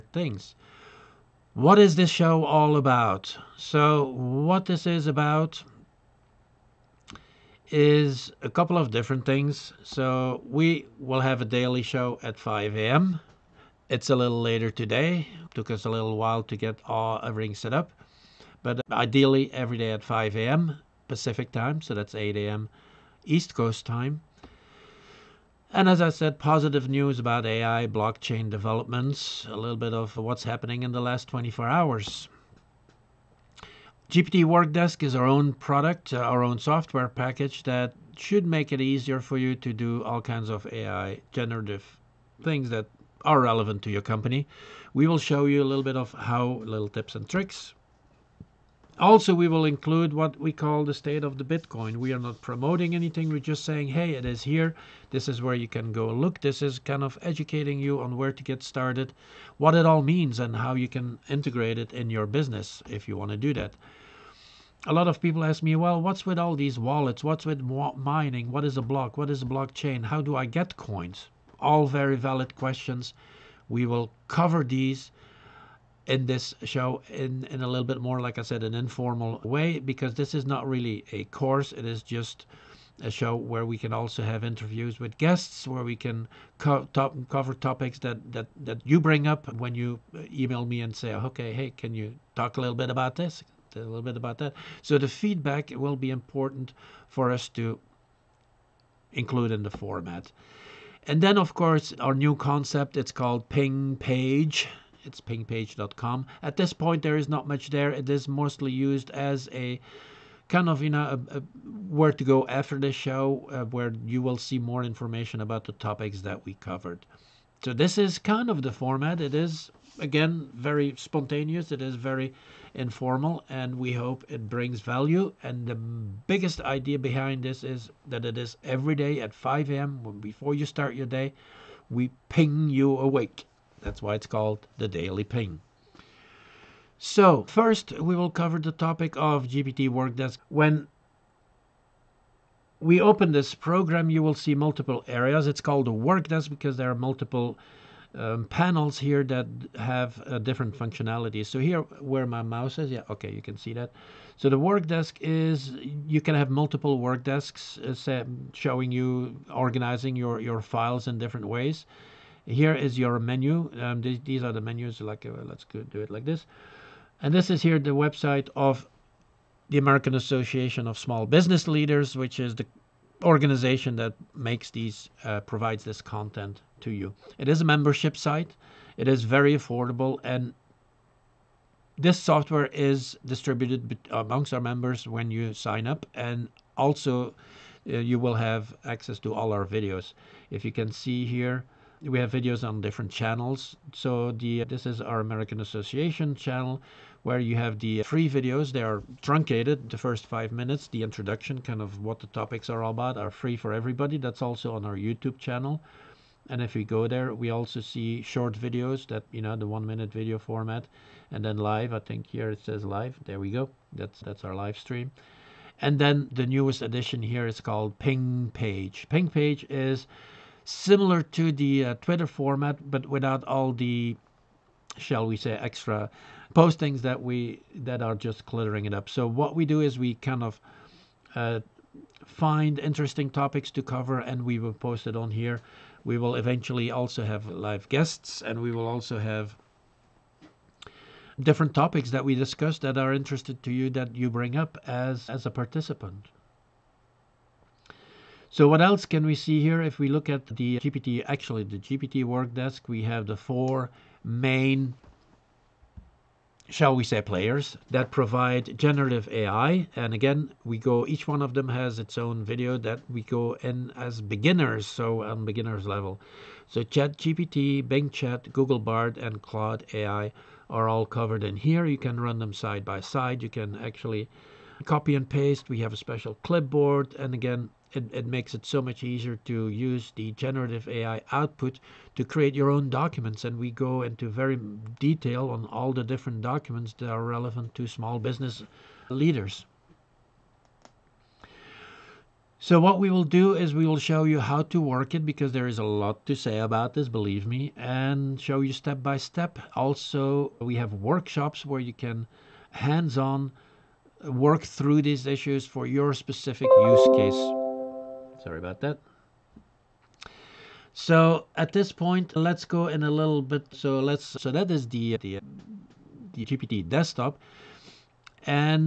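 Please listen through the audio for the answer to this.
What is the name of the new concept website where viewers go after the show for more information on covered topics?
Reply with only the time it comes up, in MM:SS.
01:45.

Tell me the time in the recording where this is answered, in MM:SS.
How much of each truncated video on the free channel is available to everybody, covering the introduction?
03:19.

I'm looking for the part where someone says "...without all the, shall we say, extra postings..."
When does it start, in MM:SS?
03:43.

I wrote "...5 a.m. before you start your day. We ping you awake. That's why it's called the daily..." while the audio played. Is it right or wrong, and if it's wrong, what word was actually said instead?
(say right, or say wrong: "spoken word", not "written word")
right.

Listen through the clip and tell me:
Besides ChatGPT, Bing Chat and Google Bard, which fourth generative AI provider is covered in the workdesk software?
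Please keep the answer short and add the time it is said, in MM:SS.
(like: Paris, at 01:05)
Claude AI, at 04:29.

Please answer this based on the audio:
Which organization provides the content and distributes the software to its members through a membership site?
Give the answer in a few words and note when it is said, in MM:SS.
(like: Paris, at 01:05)
American Association of Small Business Leaders, at 02:49.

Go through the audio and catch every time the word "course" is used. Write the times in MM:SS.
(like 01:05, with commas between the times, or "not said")
01:21, 01:41.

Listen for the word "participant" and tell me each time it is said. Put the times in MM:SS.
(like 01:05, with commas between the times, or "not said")
04:05.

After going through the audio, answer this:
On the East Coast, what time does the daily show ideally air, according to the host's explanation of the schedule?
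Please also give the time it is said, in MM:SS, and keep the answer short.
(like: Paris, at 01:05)
8 a.m., at 00:22.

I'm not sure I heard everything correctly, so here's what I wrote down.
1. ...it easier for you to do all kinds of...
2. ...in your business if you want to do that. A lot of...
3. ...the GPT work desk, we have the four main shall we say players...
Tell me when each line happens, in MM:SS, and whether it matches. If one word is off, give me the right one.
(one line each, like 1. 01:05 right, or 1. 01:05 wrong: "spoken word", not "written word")
1. 00:38 right
2. 01:01 right
3. 04:11 right.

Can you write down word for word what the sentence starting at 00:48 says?
Also, we will include what we call the state of the Bitcoin.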